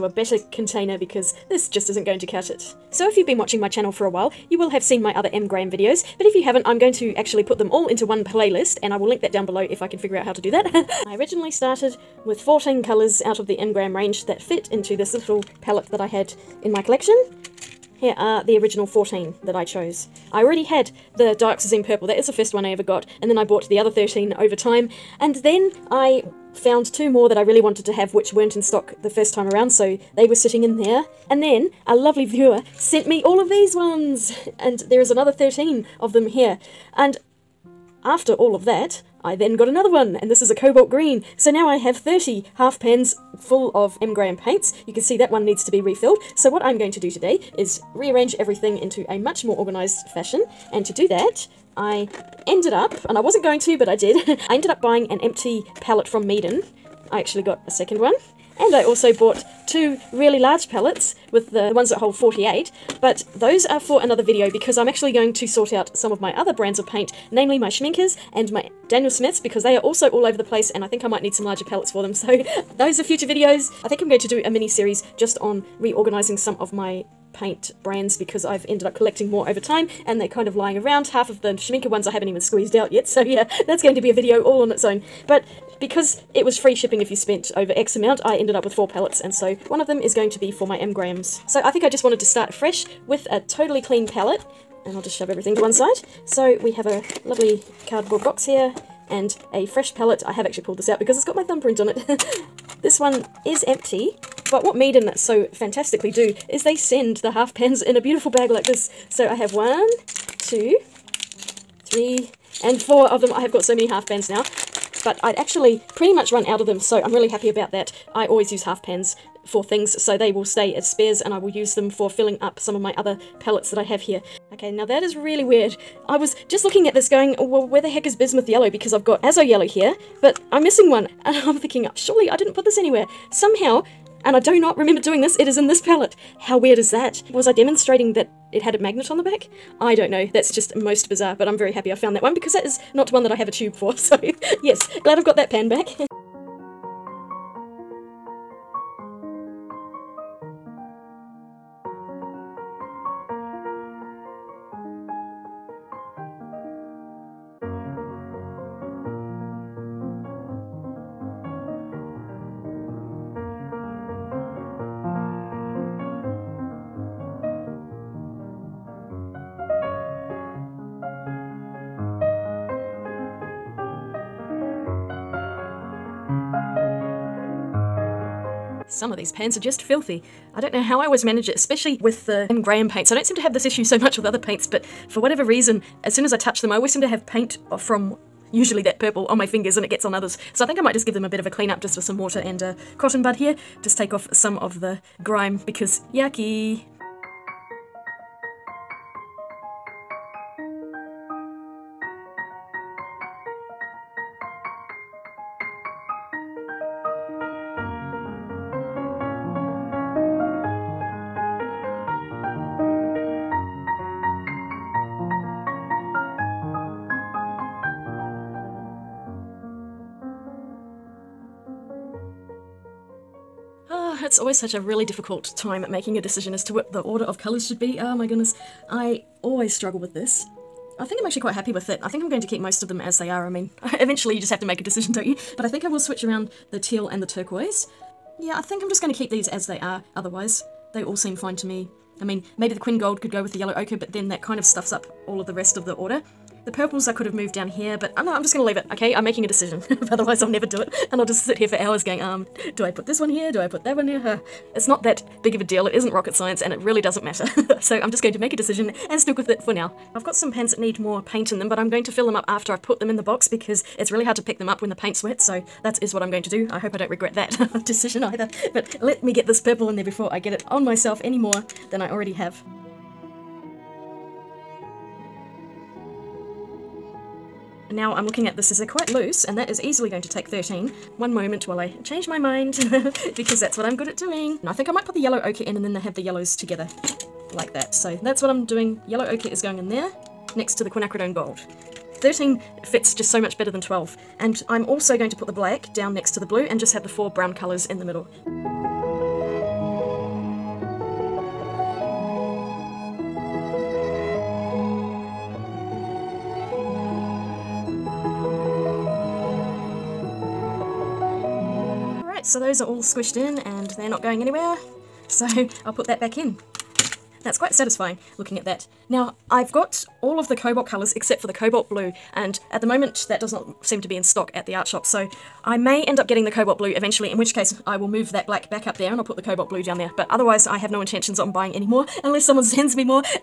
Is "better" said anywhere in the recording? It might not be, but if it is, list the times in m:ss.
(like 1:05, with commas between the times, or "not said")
0:00, 4:53.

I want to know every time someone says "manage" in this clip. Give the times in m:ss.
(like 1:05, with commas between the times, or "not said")
3:01.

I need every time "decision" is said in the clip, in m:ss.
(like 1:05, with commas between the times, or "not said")
3:46, 3:54, 4:09, 4:18, 4:27.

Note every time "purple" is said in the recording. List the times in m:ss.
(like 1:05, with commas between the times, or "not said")
0:21, 3:08, 4:06, 4:29.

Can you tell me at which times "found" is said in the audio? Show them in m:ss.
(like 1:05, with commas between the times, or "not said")
0:26, 2:21.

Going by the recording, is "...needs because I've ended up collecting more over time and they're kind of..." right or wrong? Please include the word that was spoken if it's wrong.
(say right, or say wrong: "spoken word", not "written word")
wrong: "brands", not "needs".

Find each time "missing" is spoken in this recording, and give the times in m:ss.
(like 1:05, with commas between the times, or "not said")
2:10.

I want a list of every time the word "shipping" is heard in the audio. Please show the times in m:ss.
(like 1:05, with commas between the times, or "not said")
1:26.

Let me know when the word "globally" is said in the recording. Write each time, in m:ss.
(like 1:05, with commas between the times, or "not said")
not said.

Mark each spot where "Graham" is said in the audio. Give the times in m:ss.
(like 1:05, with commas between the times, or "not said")
0:05, 0:13, 0:44, 1:30, 3:02.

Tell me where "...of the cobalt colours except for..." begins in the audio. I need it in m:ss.
5:20.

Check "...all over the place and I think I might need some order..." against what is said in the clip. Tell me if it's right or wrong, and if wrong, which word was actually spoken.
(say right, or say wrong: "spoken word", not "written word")
wrong: "larger", not "order".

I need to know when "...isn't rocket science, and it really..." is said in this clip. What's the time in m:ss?
4:15.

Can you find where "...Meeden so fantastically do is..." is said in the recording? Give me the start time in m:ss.
1:44.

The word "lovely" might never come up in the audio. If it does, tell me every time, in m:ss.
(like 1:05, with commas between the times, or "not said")
0:31, 1:37.